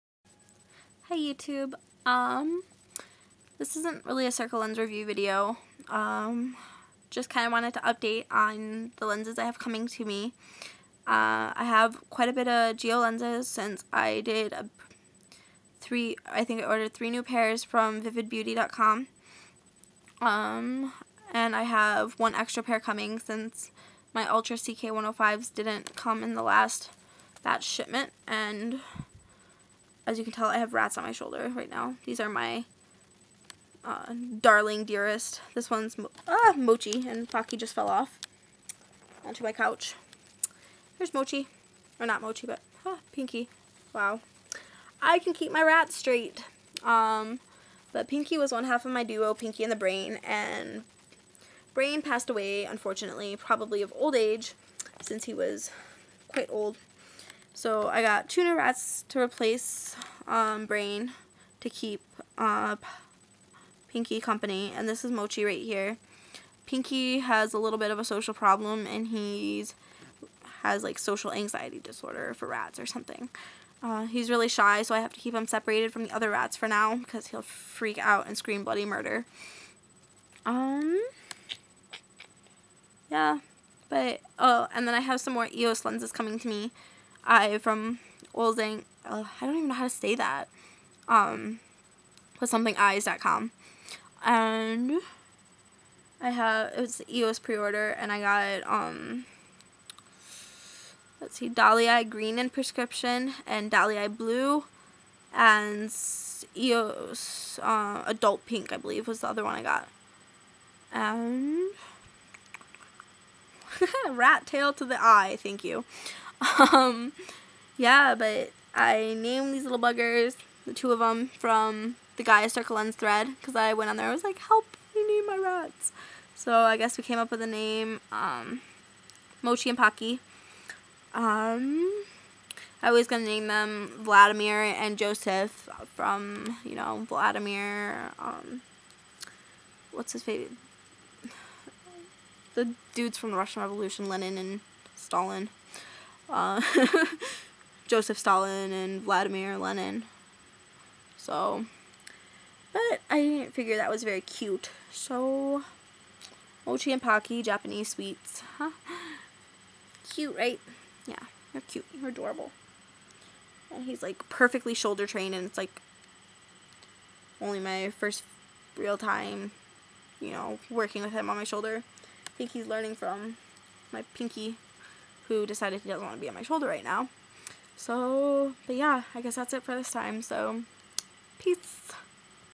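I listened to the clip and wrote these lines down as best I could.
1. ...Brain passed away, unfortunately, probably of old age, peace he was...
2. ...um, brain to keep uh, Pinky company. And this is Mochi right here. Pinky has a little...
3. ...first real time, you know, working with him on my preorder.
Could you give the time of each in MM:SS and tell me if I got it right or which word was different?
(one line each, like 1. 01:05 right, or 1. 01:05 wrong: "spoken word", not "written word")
1. 00:51 wrong: "since", not "peace"
2. 01:00 right
3. 02:47 wrong: "shoulder", not "preorder".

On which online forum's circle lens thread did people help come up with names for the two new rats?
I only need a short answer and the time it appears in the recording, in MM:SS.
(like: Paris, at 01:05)
Gaia, at 02:02.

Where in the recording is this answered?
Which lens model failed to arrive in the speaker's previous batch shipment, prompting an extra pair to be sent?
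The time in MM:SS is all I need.
00:24.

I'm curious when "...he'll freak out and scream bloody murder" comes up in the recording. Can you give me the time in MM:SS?
01:17.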